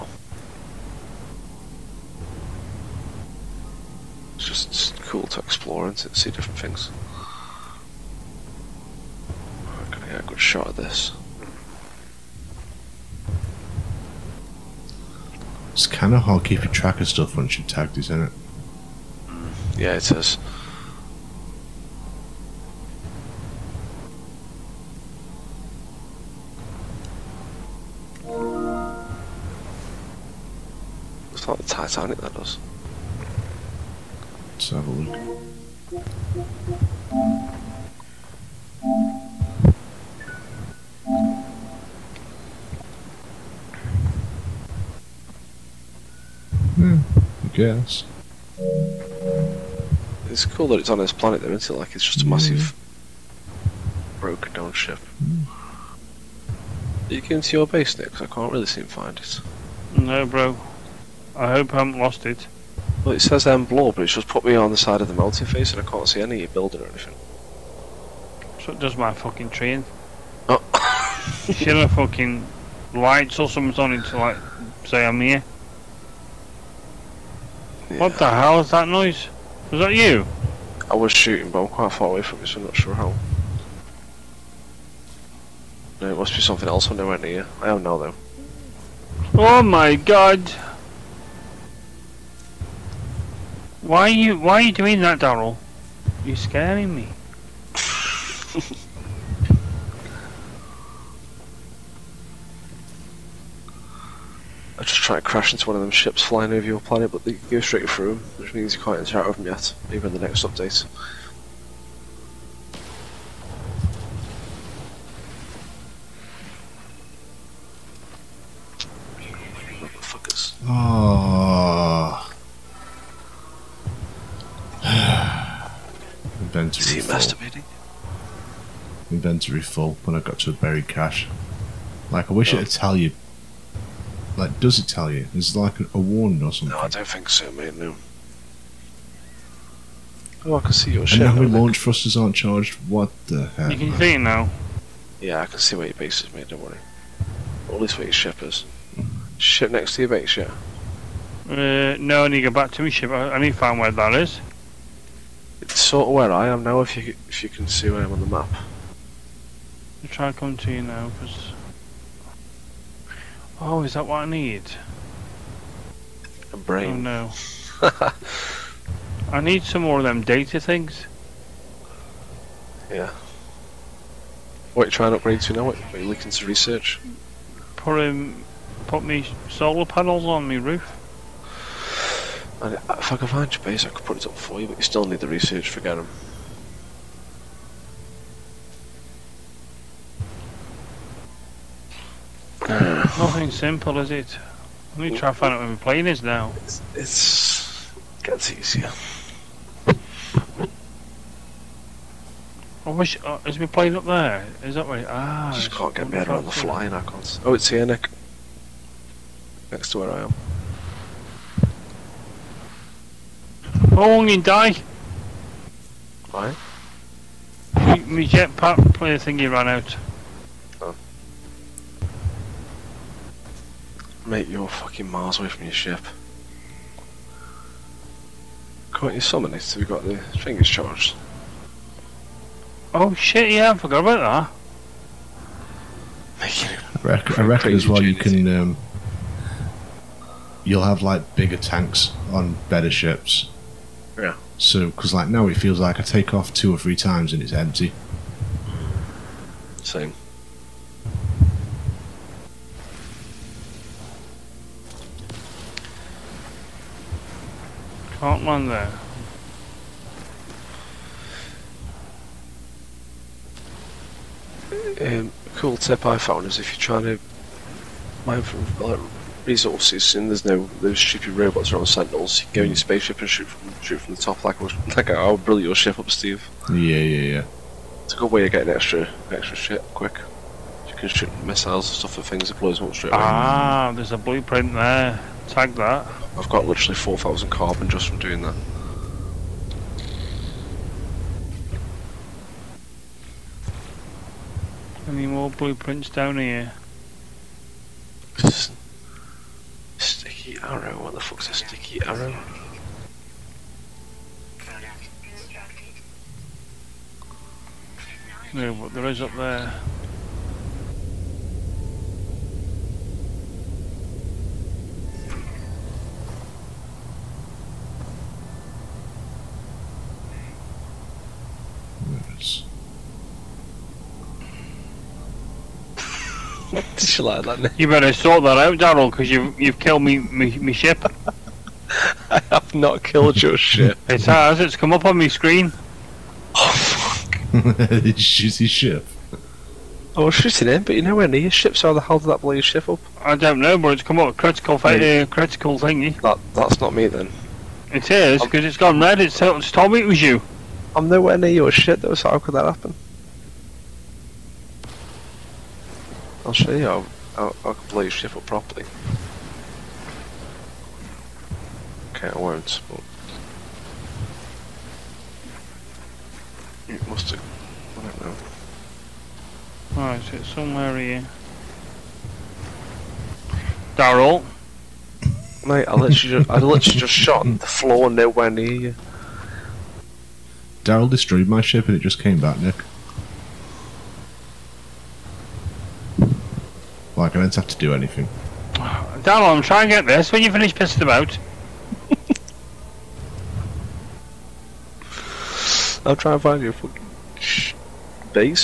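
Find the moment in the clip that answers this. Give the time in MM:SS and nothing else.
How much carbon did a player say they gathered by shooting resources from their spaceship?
04:46.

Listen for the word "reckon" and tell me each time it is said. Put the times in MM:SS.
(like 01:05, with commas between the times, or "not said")
03:57.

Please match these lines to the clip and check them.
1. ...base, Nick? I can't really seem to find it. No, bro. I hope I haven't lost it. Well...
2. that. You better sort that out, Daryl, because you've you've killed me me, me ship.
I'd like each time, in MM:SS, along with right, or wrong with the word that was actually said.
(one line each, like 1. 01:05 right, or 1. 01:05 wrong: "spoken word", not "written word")
1. 00:57 right
2. 05:27 right.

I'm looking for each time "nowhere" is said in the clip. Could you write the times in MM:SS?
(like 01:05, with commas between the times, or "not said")
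05:41, 05:51, 06:18.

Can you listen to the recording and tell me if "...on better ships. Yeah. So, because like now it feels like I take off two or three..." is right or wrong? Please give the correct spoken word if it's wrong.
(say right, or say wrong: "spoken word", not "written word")
right.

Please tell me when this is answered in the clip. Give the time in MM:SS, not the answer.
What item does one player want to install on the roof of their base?
02:59.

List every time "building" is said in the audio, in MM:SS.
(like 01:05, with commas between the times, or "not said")
01:06.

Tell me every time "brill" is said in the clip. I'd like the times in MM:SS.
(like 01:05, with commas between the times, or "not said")
04:35.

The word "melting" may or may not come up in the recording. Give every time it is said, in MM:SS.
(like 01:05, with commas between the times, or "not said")
01:05.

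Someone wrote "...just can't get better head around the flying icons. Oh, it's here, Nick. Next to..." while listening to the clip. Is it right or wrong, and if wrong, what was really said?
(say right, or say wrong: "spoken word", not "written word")
right.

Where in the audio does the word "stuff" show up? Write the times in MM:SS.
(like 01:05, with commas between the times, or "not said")
00:17, 04:41.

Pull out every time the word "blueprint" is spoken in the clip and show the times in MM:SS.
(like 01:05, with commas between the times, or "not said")
04:44, 04:55.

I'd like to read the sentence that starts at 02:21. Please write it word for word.
And now we launch thrusters aren't charged.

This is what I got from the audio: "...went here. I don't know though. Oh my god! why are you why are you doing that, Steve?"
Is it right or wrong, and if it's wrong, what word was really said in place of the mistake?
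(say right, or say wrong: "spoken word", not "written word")
wrong: "Daryl", not "Steve".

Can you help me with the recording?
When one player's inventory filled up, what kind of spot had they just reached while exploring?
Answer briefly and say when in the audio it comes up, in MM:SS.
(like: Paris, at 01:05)
buried cache, at 02:10.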